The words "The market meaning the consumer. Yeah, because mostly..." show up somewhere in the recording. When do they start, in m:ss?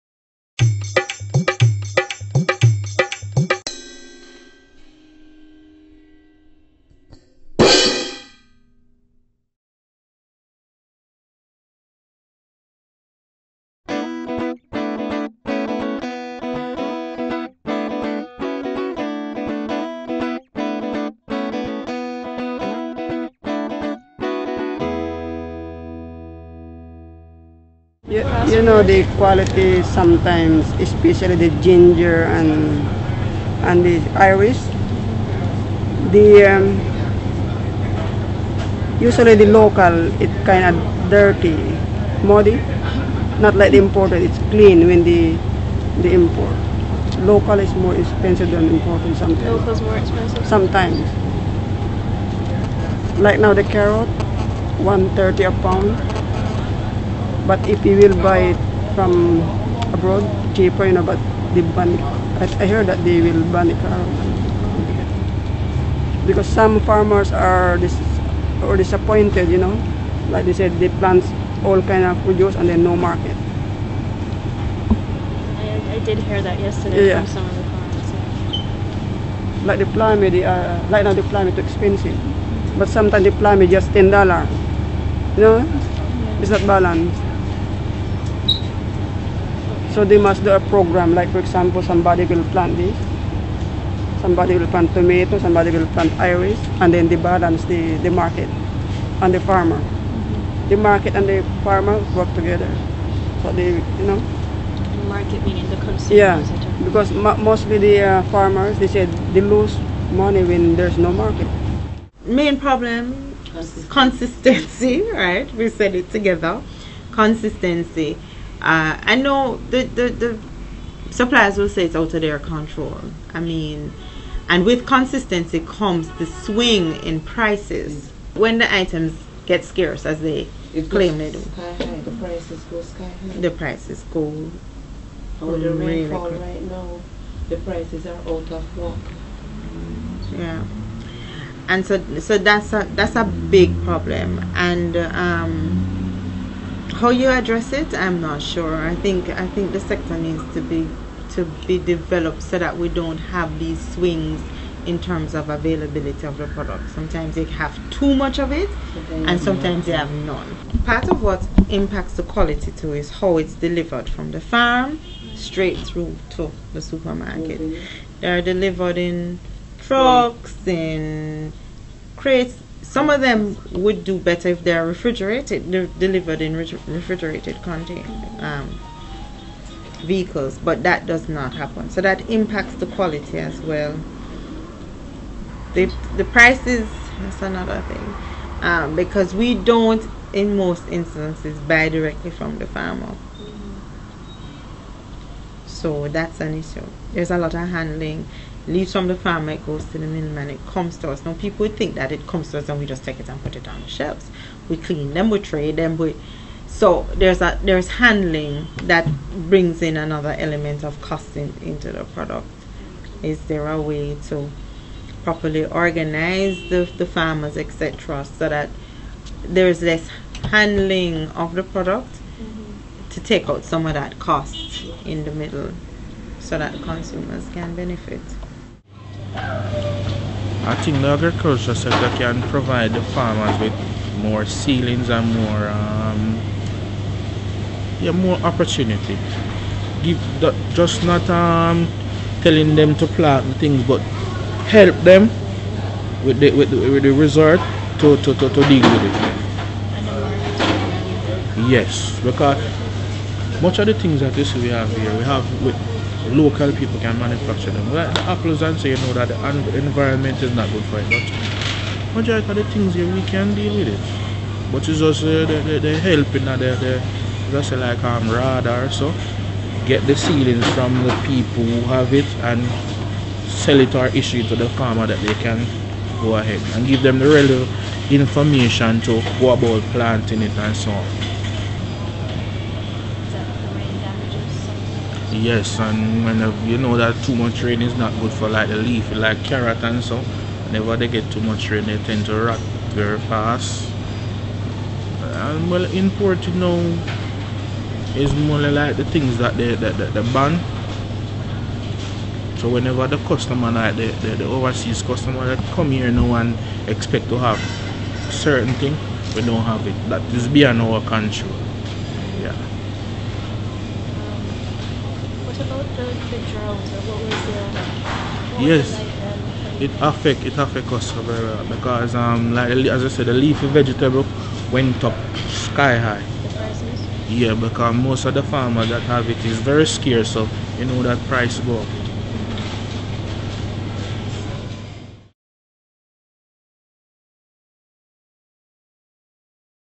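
1:44.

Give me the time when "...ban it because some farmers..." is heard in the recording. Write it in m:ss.
1:03.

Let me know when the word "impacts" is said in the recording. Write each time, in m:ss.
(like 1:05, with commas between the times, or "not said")
2:41, 3:02.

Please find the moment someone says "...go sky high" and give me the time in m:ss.
2:12.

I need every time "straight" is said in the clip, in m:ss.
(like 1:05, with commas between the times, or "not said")
2:45.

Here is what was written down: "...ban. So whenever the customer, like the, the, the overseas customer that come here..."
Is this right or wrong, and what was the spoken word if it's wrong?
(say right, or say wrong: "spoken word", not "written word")
right.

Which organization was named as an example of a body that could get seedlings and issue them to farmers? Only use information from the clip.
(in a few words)
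RADA.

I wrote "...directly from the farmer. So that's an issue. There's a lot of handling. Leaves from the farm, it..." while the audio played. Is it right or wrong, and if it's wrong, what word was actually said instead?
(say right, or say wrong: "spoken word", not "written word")
right.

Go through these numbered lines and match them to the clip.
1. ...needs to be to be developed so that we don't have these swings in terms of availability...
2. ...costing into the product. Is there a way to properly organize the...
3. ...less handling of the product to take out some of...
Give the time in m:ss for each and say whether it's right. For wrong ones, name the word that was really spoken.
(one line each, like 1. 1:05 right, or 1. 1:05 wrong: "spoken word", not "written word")
1. 2:30 right
2. 3:31 right
3. 3:39 right.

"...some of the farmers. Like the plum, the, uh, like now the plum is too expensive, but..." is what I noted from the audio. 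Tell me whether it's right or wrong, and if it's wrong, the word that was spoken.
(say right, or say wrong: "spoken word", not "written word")
right.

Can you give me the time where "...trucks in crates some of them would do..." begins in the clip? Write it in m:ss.
2:49.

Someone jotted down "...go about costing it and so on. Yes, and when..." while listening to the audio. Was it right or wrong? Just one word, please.
wrong.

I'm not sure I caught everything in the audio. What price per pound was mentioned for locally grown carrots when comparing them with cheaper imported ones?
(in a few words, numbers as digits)
130.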